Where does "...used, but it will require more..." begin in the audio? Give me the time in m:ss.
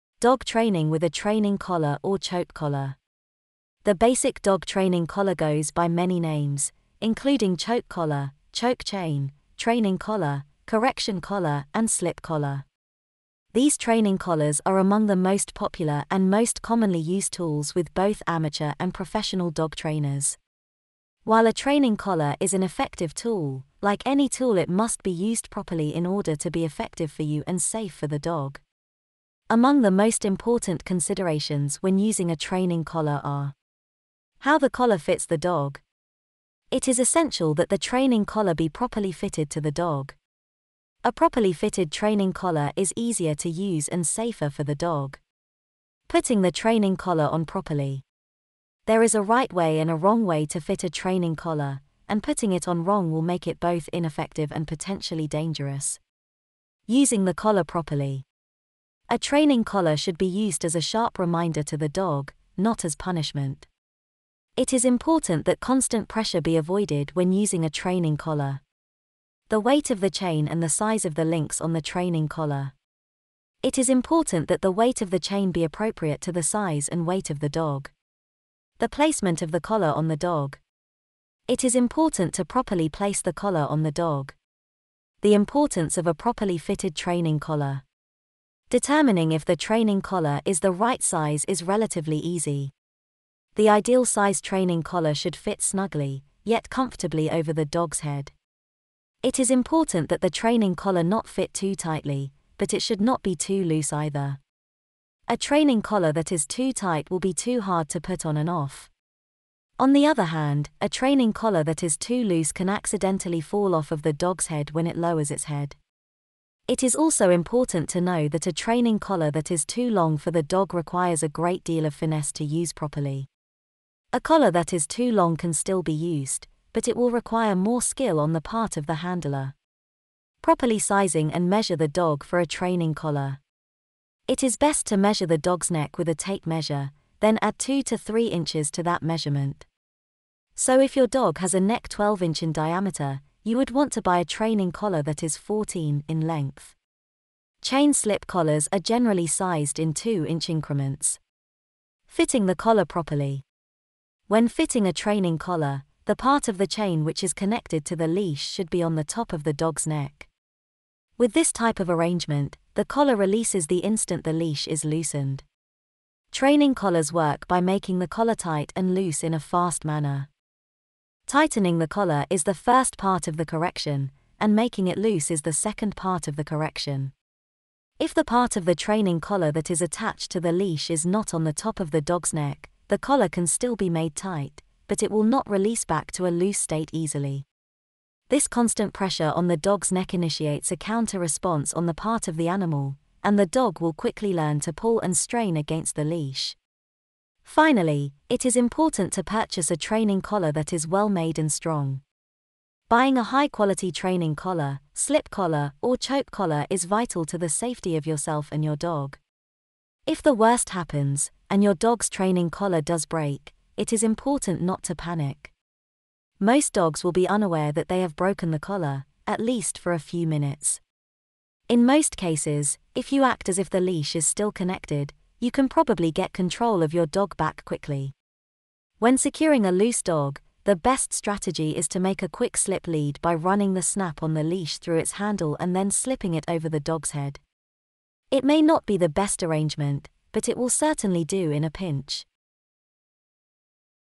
2:05.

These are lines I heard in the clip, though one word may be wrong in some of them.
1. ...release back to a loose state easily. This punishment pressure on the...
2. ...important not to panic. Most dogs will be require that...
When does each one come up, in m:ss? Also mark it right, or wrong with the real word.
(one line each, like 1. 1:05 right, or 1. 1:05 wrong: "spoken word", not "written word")
1. 3:05 wrong: "constant", not "punishment"
2. 3:34 wrong: "unaware", not "require".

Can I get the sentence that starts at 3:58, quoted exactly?
It may not be the best arrangement, but it will certainly do in a pinch.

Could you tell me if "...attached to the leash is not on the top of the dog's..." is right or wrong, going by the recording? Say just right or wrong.
right.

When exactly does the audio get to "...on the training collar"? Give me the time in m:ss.
1:11.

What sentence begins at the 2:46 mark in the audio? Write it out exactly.
Training collars work by making the collar tight and loose in a fast manner.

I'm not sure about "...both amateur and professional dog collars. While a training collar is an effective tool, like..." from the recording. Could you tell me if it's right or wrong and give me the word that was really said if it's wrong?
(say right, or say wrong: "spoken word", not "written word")
wrong: "trainers", not "collars".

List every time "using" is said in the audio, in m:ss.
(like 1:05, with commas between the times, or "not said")
0:31, 0:56, 1:07.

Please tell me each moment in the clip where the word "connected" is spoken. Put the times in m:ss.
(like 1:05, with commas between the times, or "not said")
2:37, 3:44.